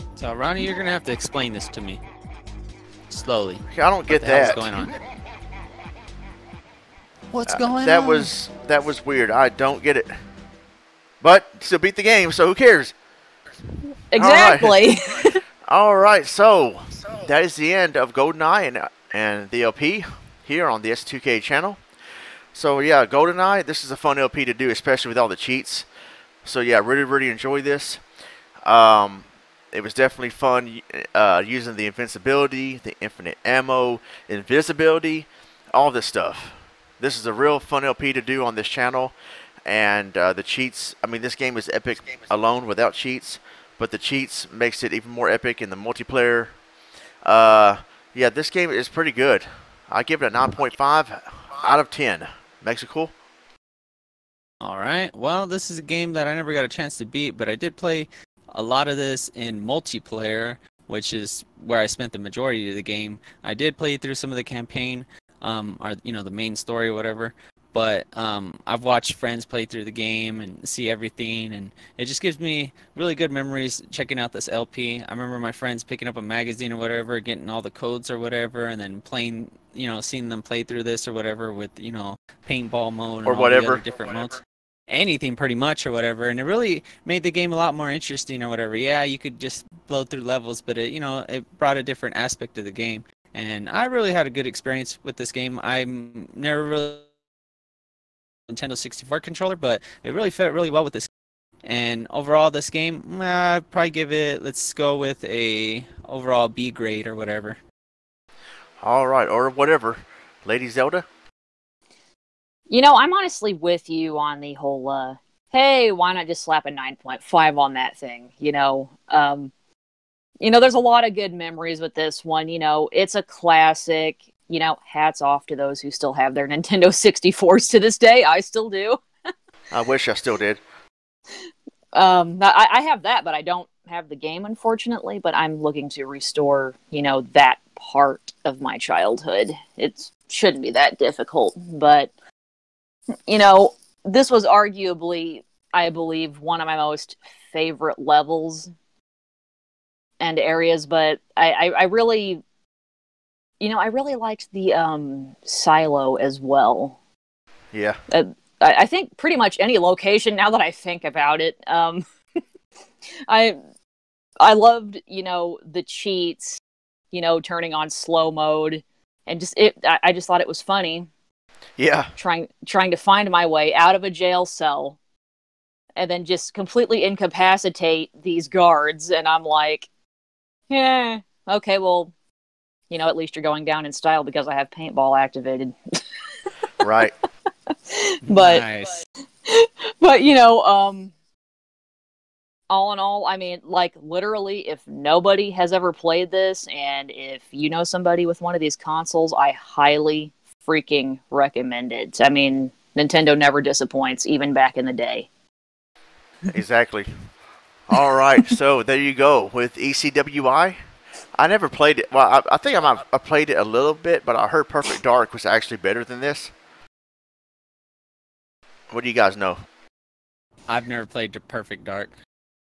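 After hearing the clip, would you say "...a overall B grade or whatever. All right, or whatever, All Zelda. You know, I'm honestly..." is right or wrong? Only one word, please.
wrong.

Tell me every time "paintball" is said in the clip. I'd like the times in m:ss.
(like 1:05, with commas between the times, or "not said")
1:22, 3:04.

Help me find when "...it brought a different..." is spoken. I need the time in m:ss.
1:31.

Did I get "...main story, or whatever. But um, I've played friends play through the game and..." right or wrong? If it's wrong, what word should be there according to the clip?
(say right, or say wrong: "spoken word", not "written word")
wrong: "watched", not "played".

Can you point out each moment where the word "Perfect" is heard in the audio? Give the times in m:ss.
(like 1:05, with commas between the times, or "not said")
3:34, 3:41.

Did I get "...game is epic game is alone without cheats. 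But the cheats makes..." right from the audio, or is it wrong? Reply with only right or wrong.
right.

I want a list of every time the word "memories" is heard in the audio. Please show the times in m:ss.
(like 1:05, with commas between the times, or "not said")
1:13, 2:01.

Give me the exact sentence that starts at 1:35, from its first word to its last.
I'm never really Nintendo 64 controller, but it really fit really well with this.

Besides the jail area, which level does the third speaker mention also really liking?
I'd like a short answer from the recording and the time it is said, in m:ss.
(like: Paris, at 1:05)
Silo, at 2:35.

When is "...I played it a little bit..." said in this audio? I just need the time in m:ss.
3:33.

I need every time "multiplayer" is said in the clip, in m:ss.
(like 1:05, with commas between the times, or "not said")
0:45, 0:59.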